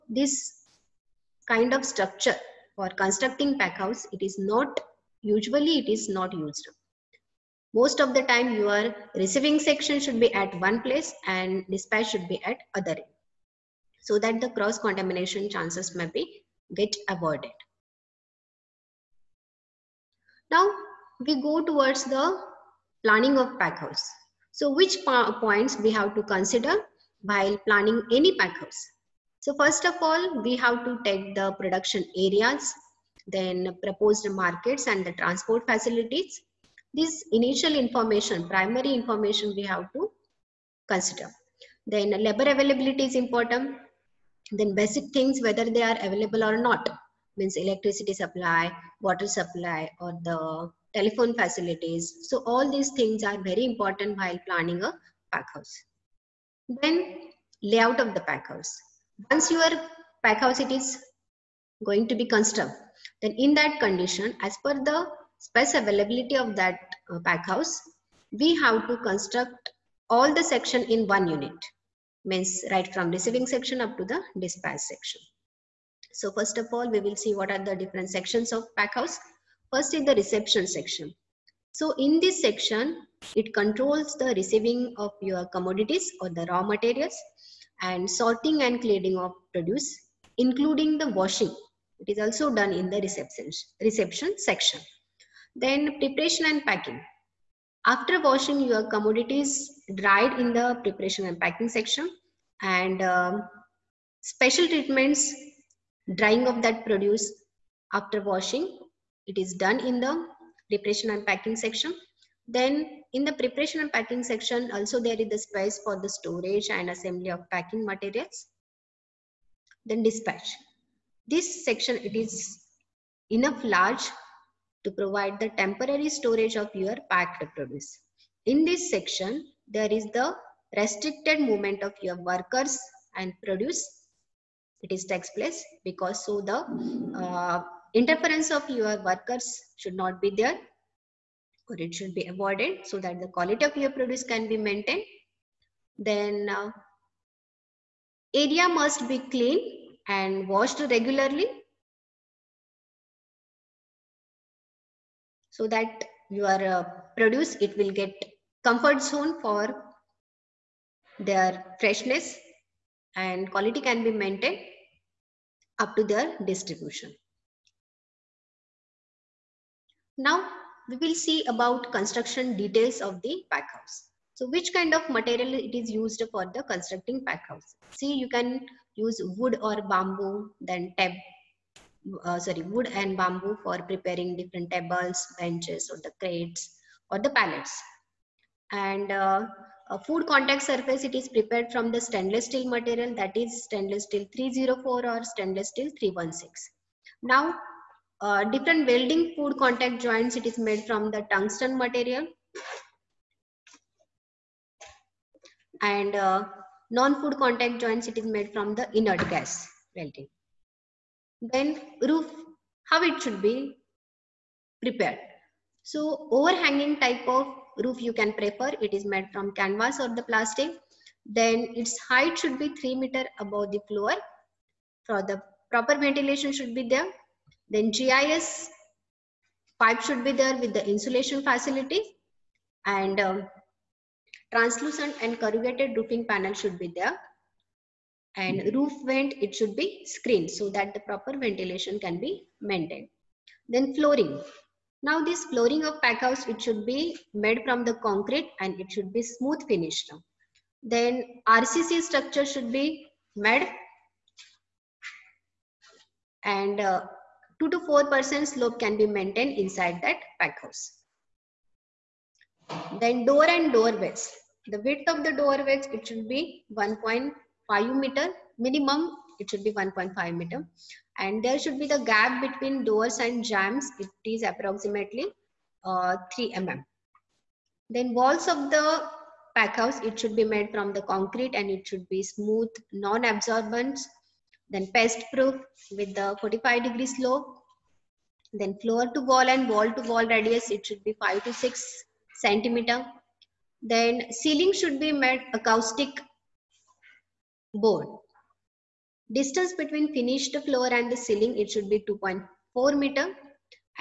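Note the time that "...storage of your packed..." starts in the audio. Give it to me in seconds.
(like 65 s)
126 s.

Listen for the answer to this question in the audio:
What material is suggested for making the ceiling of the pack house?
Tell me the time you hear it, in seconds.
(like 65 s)
295 s.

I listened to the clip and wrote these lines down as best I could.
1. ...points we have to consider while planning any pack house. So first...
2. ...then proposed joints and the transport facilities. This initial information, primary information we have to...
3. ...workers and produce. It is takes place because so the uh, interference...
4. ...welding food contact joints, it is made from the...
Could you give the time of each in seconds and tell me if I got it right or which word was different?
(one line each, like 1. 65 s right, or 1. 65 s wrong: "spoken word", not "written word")
1. 25 s right
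2. 33 s wrong: "markets", not "joints"
3. 132 s right
4. 198 s right.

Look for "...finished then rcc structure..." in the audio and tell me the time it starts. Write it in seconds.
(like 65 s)
249 s.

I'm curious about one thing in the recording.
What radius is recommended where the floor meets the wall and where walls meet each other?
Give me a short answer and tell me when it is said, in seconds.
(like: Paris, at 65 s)
5 to 6 cm, at 291 s.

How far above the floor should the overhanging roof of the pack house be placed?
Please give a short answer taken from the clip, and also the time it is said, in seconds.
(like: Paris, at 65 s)
3 meters, at 222 s.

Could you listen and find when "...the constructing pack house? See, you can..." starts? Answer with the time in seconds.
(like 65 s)
176 s.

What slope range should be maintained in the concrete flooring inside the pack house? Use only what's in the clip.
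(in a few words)
2 to 4%.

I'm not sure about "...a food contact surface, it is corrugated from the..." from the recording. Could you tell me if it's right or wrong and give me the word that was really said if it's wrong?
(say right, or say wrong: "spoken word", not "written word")
wrong: "prepared", not "corrugated".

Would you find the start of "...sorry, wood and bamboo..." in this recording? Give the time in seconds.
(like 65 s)
182 s.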